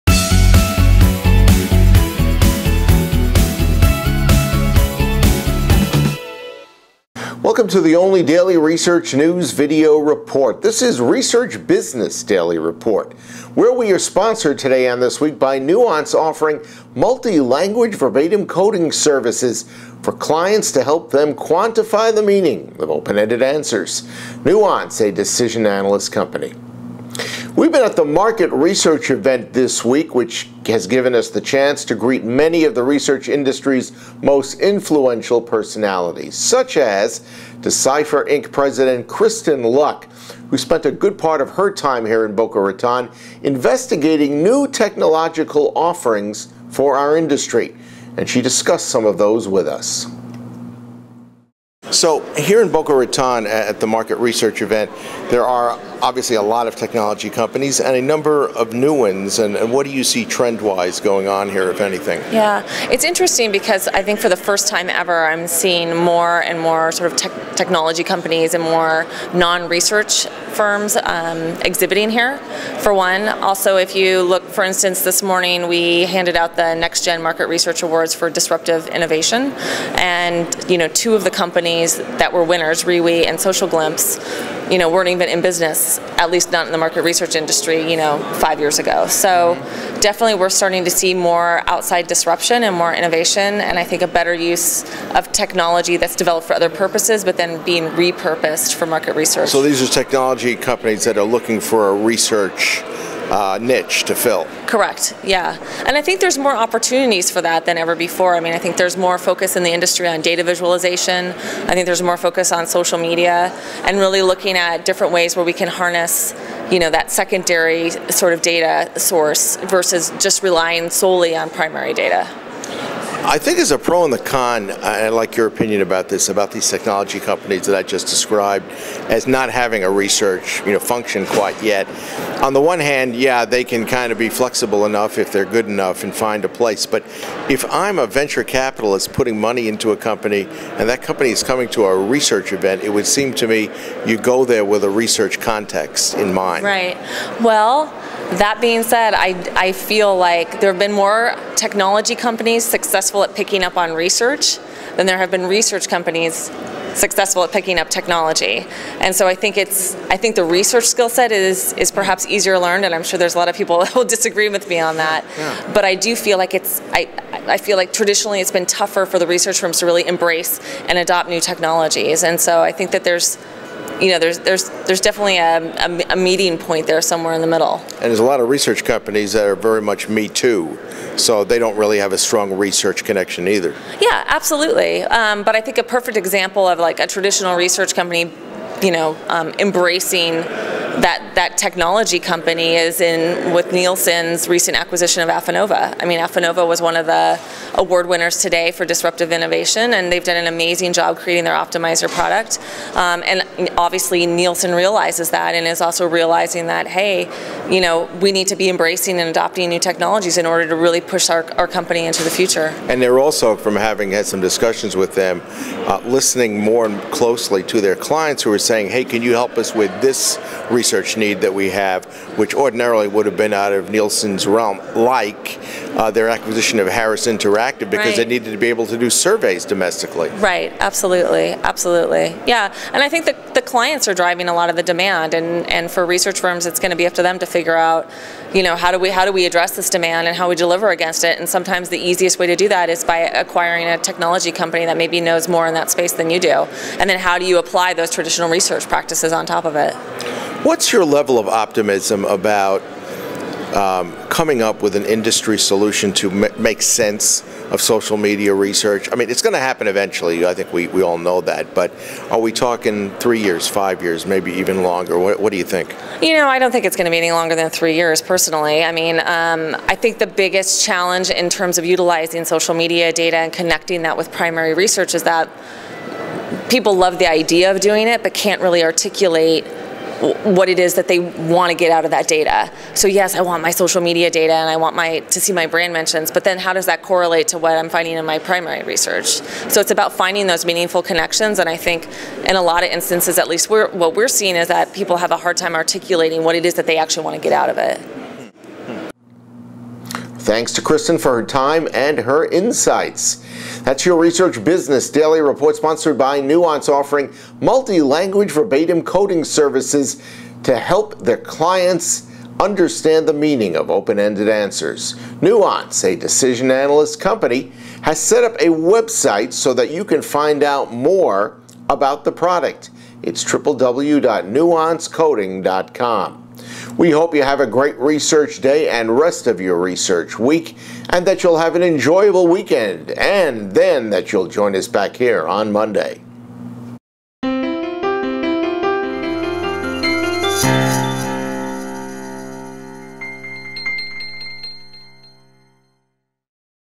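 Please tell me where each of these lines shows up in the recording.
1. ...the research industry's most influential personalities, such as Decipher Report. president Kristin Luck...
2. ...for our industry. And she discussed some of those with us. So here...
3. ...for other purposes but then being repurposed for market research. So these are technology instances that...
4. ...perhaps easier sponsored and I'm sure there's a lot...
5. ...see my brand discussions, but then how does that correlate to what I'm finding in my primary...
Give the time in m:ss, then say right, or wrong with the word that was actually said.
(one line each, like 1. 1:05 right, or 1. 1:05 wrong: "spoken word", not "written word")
1. 0:32 wrong: "Inc", not "Report"
2. 0:46 right
3. 1:36 wrong: "companies", not "instances"
4. 2:41 wrong: "learned", not "sponsored"
5. 4:45 wrong: "mentions", not "discussions".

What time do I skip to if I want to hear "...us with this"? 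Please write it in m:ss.
3:39.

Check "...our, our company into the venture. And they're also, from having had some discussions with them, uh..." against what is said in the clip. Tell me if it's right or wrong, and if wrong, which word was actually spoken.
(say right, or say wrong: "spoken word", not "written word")
wrong: "future", not "venture".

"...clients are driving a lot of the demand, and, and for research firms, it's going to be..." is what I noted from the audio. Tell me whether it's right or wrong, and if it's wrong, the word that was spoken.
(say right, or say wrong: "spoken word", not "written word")
right.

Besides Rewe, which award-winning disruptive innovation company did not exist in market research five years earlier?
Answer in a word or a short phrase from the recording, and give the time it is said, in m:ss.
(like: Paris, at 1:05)
Social Glimpse, at 1:23.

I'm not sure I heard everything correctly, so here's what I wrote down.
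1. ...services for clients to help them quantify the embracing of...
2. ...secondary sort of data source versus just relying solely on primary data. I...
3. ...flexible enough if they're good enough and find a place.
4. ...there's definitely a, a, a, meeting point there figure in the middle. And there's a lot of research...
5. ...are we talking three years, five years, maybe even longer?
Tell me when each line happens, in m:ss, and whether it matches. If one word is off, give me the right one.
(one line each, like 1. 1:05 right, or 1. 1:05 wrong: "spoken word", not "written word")
1. 0:18 wrong: "meaning", not "embracing"
2. 1:57 right
3. 2:14 right
4. 2:54 wrong: "somewhere", not "figure"
5. 4:22 right.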